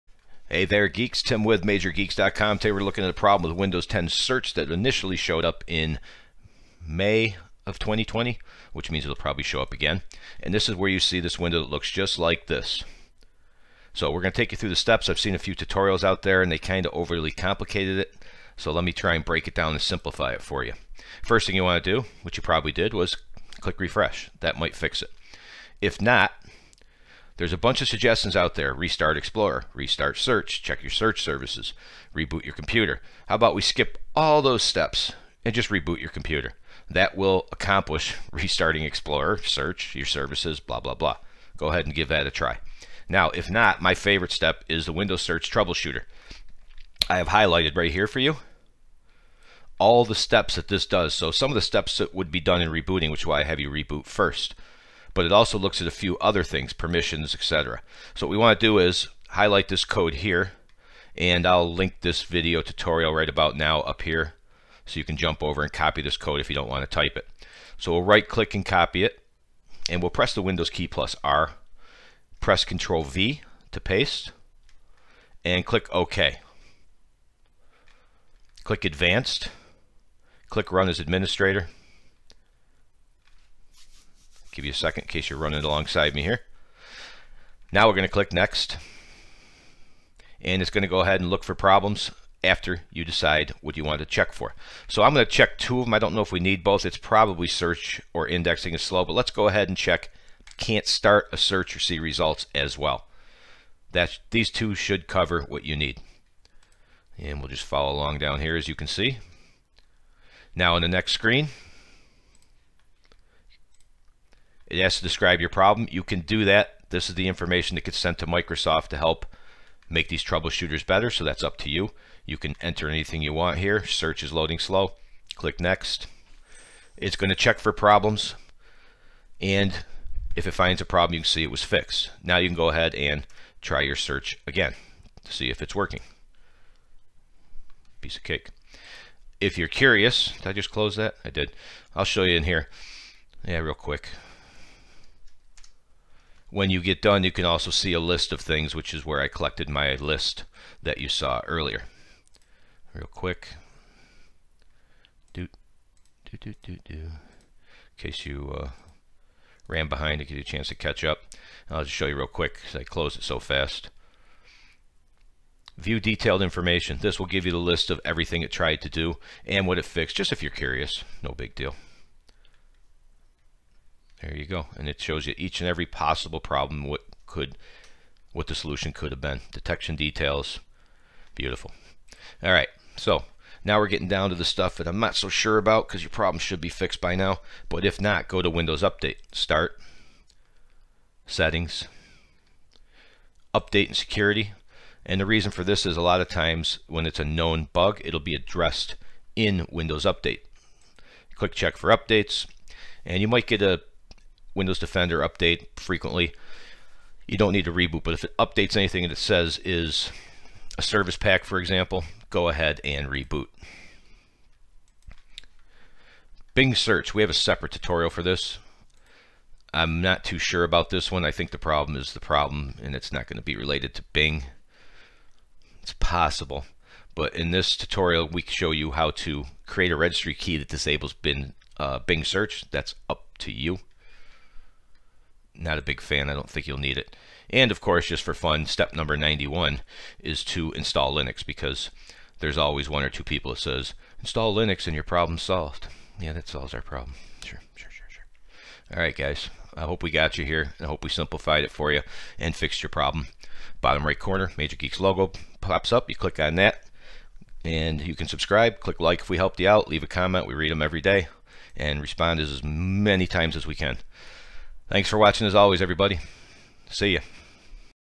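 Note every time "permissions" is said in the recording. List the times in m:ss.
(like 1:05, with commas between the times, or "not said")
0:56.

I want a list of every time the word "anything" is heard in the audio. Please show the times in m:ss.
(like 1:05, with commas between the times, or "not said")
2:02, 3:28.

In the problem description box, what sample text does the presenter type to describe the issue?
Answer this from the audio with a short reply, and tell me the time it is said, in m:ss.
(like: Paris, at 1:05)
Search is loading slow, at 2:03.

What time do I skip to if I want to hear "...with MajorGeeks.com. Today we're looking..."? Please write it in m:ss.
0:01.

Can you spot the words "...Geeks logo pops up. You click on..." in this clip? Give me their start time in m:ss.
4:14.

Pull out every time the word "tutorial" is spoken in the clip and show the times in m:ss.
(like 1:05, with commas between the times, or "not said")
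0:15, 1:02, 3:37, 3:47.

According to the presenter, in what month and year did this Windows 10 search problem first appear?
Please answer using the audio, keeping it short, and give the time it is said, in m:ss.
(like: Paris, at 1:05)
May 2020, at 0:06.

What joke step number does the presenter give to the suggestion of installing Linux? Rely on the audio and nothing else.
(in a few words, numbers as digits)
91.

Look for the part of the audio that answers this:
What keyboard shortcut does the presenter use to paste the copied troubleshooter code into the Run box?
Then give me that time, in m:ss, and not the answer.
1:12.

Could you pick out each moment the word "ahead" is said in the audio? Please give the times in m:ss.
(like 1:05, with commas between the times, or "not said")
0:41, 1:31, 1:39, 2:12, 3:32.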